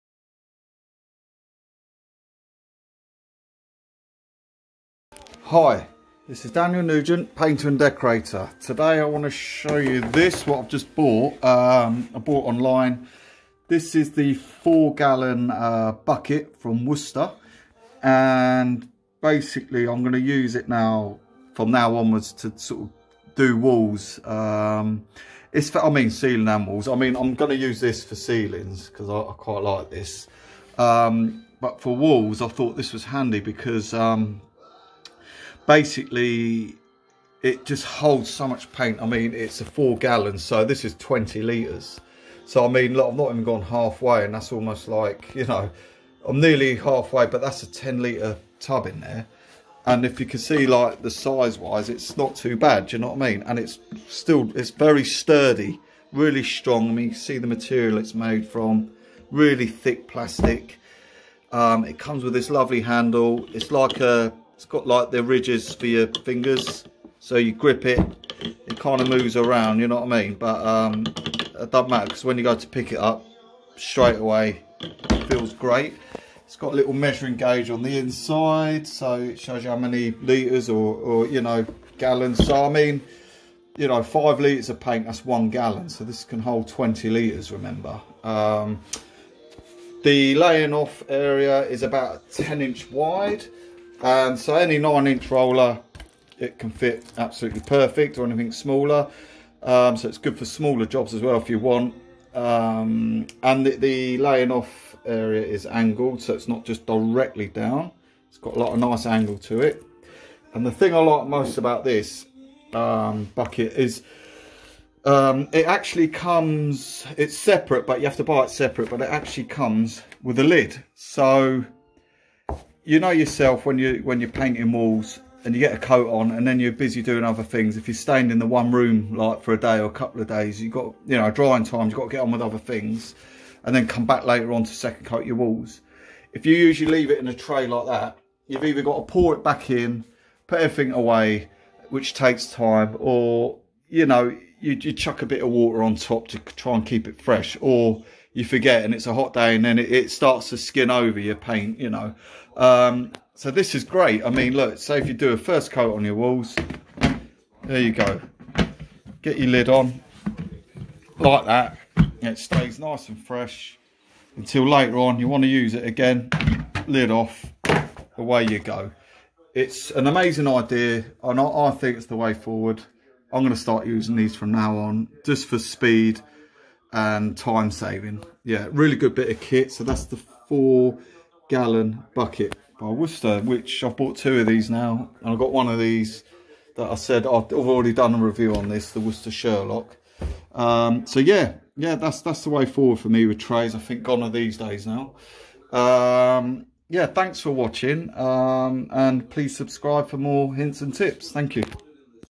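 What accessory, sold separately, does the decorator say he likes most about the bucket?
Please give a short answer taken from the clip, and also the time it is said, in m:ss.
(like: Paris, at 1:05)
a lid, at 2:00.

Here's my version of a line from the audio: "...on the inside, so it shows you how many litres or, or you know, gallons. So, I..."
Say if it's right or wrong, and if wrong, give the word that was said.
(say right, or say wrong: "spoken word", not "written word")
right.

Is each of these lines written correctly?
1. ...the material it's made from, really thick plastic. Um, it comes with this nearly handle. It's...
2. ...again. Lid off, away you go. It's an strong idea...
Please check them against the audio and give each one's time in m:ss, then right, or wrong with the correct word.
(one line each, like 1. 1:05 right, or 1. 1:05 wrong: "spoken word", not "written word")
1. 0:57 wrong: "lovely", not "nearly"
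2. 2:45 wrong: "amazing", not "strong".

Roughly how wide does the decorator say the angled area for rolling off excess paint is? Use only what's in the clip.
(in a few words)
10 inch.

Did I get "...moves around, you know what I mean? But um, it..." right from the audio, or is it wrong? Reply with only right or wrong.
right.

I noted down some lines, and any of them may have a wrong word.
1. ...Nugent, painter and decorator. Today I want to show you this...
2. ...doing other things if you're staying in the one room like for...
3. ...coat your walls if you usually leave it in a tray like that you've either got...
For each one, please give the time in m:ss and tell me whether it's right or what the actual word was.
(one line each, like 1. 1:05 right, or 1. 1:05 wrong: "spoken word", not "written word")
1. 0:06 right
2. 2:07 right
3. 2:15 right.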